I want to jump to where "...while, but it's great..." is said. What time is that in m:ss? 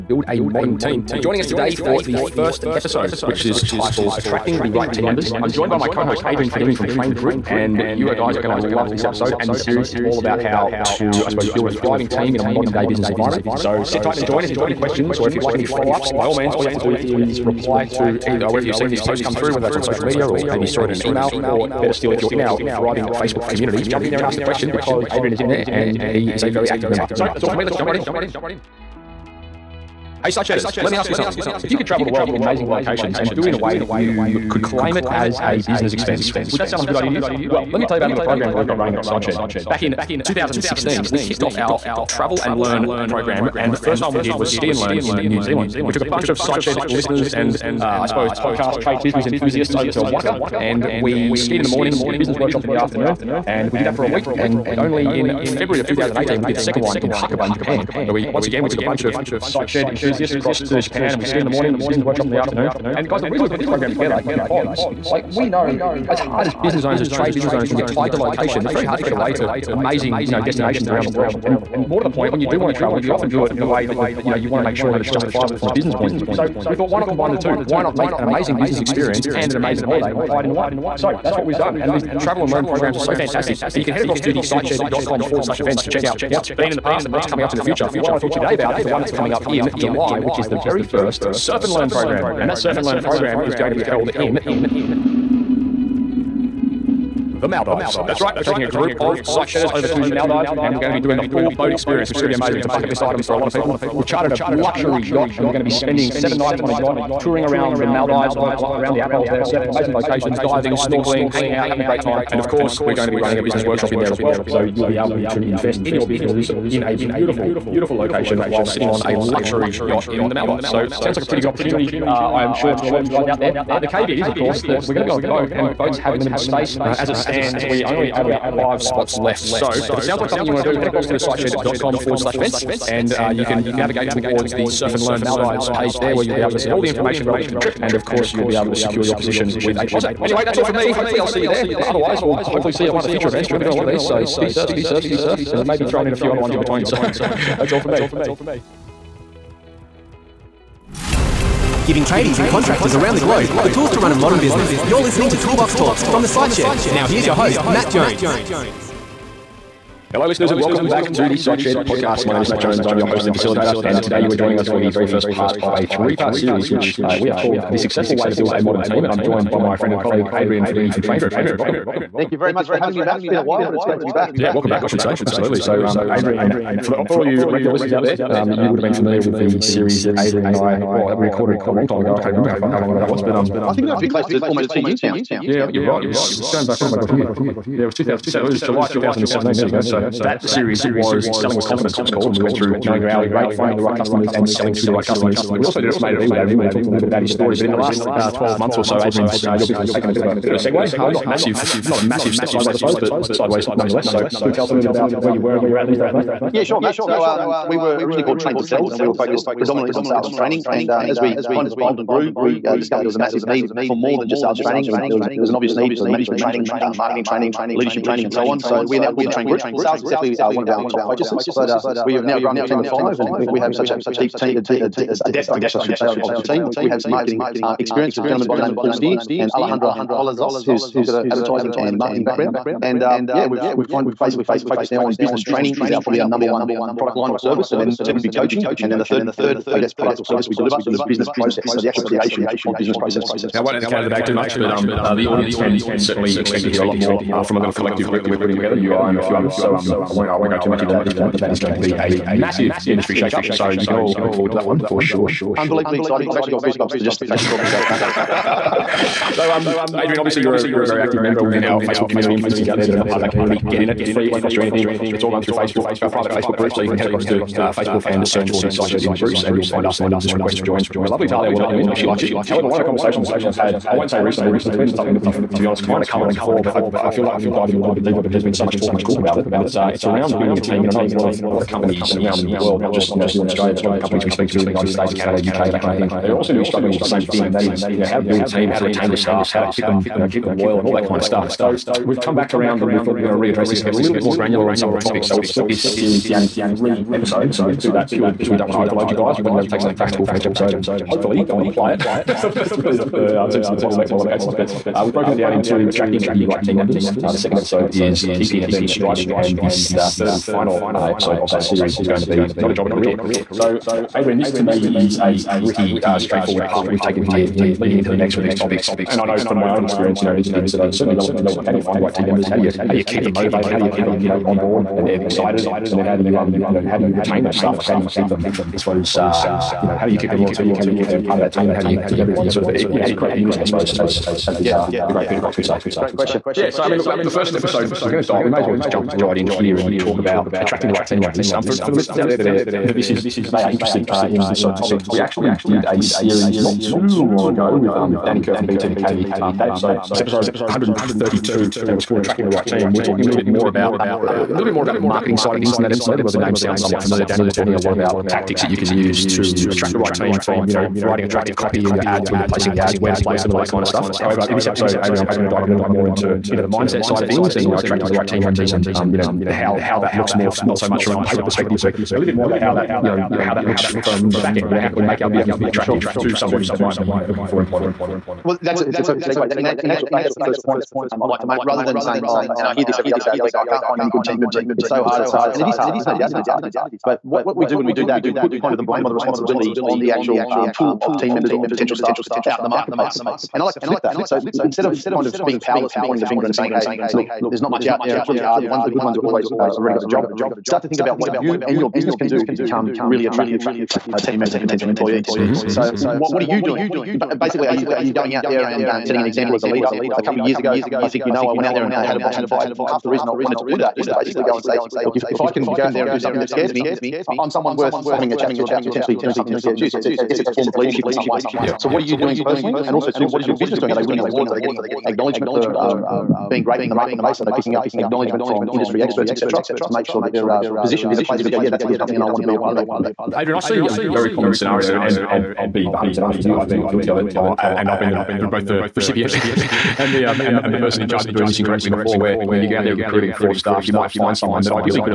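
2:53.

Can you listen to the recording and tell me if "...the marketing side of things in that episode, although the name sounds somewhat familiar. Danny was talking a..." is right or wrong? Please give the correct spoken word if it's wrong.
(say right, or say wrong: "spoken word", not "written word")
right.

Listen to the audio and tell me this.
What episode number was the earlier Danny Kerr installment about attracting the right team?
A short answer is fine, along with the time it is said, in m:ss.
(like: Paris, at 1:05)
132, at 5:50.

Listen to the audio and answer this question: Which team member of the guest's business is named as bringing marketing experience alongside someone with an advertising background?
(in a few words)
Paul Steer.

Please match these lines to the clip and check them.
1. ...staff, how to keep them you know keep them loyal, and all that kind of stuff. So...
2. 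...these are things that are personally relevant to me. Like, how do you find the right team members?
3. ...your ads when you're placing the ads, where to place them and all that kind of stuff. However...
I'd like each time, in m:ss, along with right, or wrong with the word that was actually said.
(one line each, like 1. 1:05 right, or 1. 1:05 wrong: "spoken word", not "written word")
1. 4:49 right
2. 5:20 wrong: "certainly", not "personally"
3. 6:01 right.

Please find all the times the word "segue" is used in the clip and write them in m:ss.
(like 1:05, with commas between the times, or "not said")
3:20, 6:19.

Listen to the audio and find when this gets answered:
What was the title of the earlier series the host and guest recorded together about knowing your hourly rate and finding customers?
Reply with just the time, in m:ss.
3:11.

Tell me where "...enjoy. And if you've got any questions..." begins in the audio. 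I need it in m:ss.
0:14.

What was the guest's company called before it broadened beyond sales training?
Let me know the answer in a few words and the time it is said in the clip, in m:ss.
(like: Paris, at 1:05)
Trained to Sell, at 3:28.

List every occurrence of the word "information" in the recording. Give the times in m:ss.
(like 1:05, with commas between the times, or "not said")
2:16.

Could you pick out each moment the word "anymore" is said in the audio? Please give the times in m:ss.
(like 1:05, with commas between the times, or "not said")
not said.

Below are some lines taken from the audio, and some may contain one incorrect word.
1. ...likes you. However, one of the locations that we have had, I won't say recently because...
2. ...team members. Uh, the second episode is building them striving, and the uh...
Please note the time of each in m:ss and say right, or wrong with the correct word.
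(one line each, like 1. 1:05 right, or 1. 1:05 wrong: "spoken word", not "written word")
1. 4:32 wrong: "conversations", not "locations"
2. 5:06 wrong: "keeping", not "building".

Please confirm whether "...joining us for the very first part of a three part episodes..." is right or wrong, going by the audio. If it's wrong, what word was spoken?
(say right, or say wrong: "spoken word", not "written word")
wrong: "series", not "episodes".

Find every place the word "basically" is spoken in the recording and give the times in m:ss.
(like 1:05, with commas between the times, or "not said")
3:54, 6:47, 6:54.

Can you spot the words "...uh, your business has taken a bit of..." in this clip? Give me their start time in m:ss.
3:19.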